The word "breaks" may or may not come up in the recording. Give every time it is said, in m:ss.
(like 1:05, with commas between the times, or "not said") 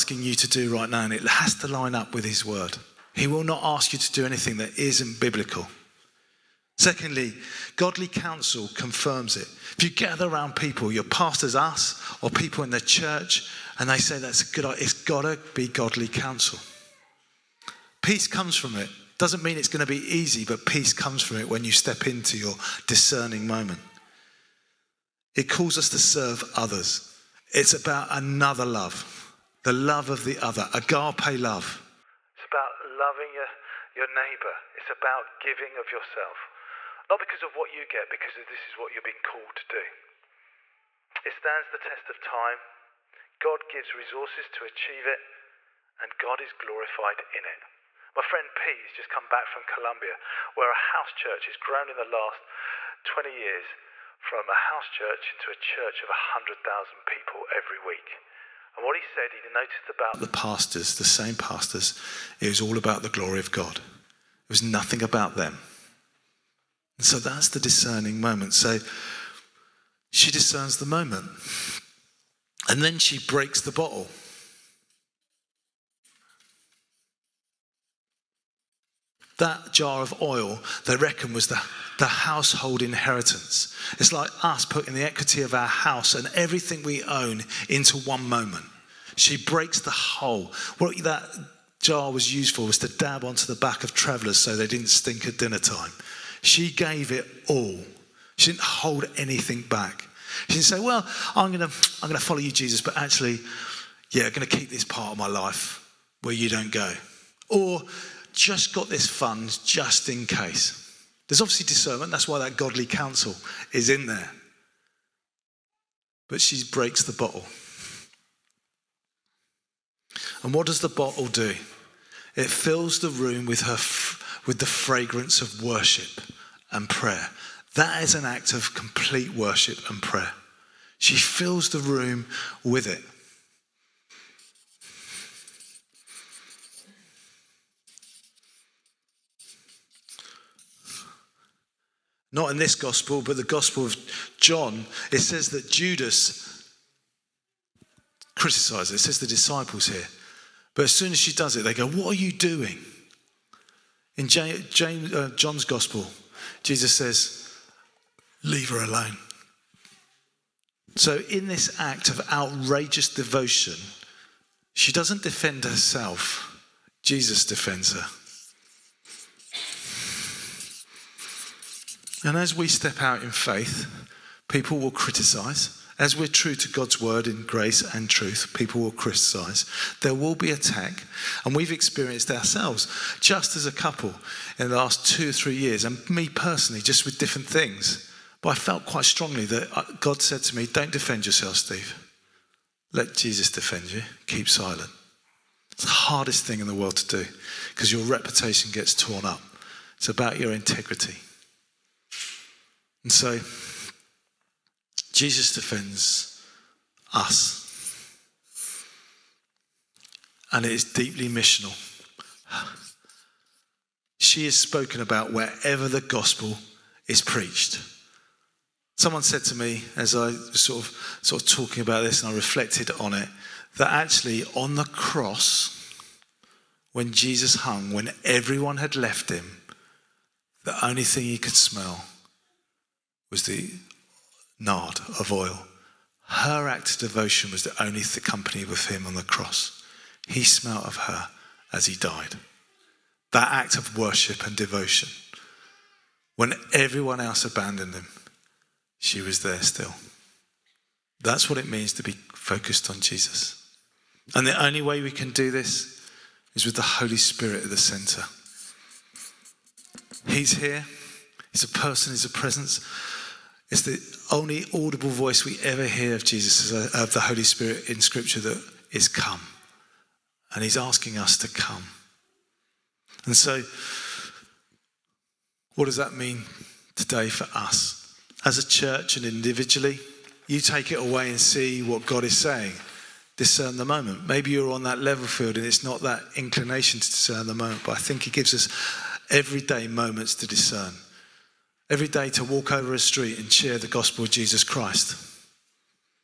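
1:13, 1:29, 1:56.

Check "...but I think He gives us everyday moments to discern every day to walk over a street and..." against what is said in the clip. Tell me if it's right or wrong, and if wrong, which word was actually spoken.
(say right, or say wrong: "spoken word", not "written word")
right.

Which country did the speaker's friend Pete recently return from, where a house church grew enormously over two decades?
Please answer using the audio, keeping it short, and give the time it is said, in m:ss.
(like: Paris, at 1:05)
Colombia, at 0:49.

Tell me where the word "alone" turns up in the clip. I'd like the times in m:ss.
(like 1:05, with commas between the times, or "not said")
2:38.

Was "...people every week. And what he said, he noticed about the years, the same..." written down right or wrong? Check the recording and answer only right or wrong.
wrong.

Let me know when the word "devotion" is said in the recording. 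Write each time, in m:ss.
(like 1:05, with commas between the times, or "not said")
2:43, 3:56, 4:04.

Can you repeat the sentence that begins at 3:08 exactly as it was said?
But I felt quite strongly that uh, God said to me, Don't defend yourself, Steve.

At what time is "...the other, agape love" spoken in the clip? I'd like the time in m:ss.
0:30.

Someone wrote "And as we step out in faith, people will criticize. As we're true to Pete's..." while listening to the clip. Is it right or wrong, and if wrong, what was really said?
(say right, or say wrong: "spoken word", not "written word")
wrong: "God", not "Pete".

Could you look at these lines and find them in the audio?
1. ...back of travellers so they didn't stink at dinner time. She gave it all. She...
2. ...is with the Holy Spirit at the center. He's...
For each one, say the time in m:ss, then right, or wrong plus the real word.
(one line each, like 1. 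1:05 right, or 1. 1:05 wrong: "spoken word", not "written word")
1. 1:33 right
2. 4:16 right.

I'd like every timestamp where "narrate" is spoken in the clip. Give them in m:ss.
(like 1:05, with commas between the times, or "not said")
not said.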